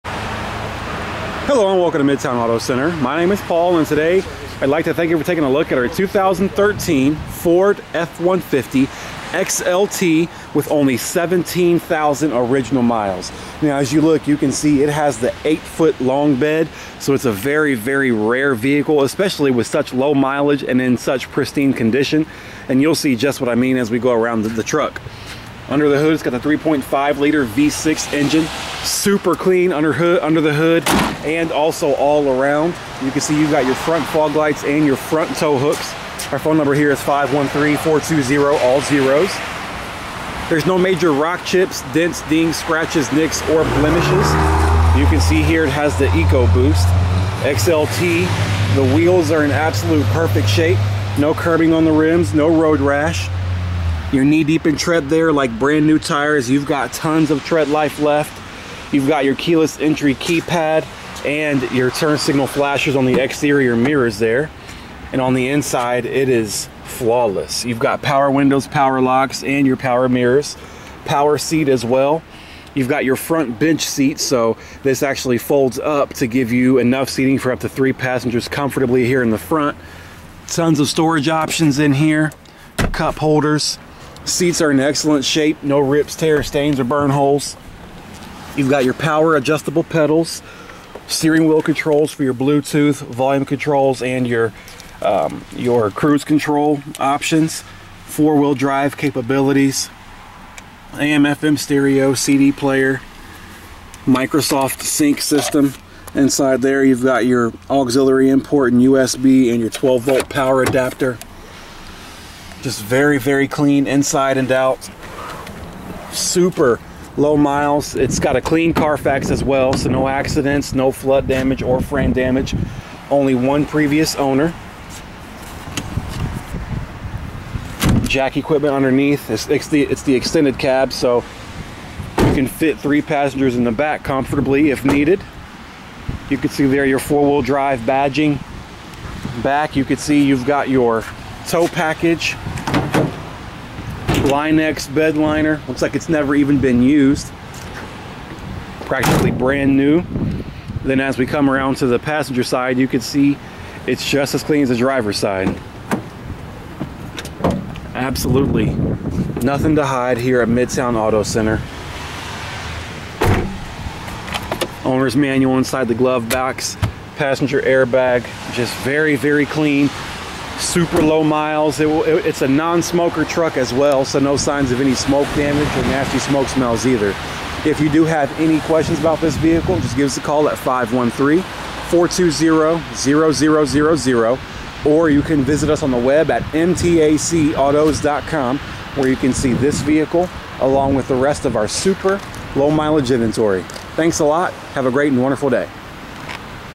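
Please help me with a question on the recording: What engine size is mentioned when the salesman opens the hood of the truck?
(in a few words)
3.5 liter V6.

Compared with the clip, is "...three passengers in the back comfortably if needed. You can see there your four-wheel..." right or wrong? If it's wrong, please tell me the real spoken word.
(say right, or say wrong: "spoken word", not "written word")
right.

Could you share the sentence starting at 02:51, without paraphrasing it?
It will, it, it's a non-smoker truck as well, so no signs of any smoke damage or nasty smoke smells either.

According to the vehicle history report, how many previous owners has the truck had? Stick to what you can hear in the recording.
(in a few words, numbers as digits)
1.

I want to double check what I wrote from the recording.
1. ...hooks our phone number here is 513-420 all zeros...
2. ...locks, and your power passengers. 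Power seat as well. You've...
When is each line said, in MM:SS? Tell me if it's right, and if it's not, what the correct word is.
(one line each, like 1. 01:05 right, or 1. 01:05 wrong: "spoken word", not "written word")
1. 00:35 right
2. 01:08 wrong: "mirrors", not "passengers".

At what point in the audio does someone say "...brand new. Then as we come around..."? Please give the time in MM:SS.
02:29.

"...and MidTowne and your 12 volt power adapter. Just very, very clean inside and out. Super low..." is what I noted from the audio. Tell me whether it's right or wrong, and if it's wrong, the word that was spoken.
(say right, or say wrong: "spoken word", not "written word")
wrong: "USB", not "MidTowne".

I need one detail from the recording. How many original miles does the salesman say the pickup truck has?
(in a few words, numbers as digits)
17,000.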